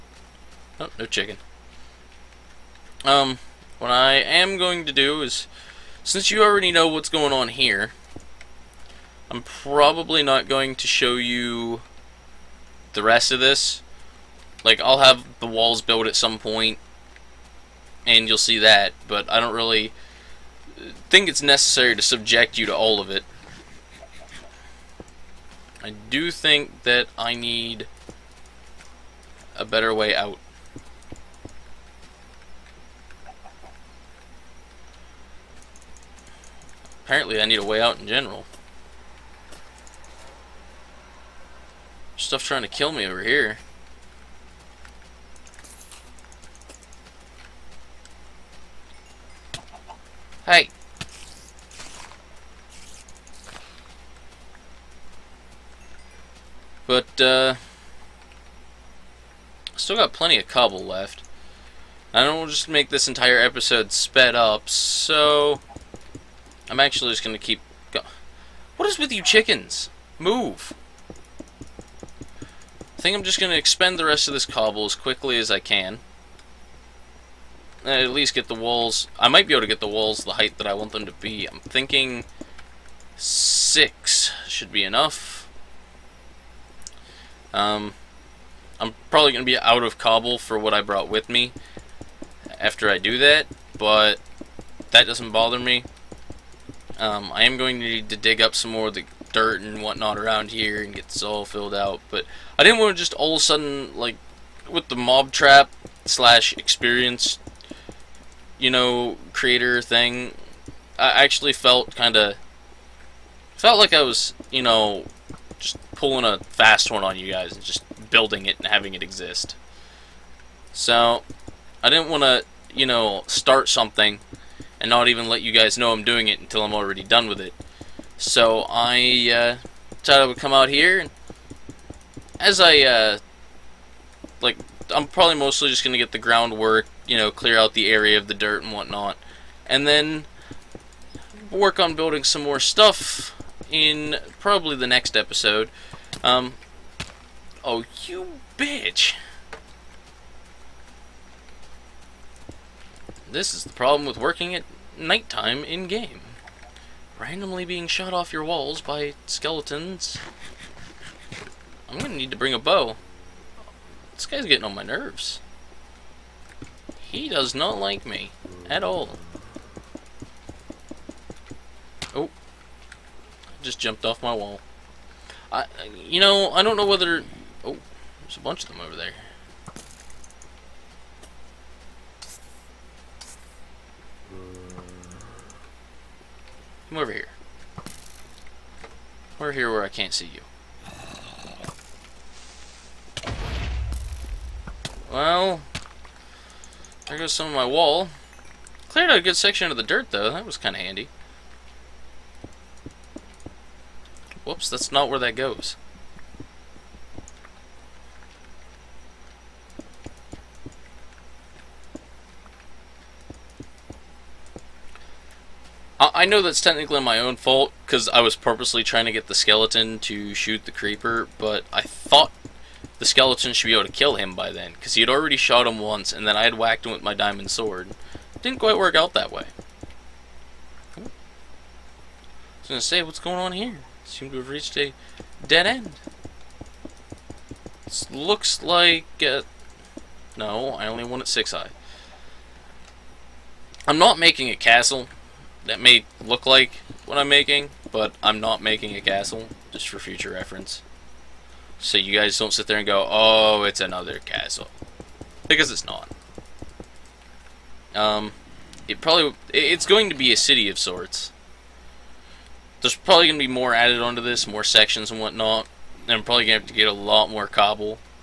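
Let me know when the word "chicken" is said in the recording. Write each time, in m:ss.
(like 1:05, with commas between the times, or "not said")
0:01, 1:09.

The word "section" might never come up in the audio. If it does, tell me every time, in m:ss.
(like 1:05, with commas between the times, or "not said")
3:19, 4:24.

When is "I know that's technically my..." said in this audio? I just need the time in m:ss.
3:36.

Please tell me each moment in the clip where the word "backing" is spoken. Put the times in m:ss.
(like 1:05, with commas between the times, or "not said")
not said.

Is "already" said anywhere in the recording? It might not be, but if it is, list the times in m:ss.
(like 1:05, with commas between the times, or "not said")
0:06, 2:06, 3:45.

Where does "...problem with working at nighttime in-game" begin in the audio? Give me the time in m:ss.
2:33.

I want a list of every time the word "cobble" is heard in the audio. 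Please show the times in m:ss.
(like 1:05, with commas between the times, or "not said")
1:00, 1:14, 1:29, 4:27.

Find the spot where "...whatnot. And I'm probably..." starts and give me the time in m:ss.
4:25.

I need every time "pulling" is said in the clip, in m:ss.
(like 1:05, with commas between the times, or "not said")
1:55.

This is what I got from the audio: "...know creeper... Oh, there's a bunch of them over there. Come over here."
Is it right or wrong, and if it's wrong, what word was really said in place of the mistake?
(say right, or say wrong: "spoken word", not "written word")
wrong: "whether", not "creeper".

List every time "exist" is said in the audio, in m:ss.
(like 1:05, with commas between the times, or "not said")
1:59.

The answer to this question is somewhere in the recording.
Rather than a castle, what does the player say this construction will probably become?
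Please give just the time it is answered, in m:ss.
4:20.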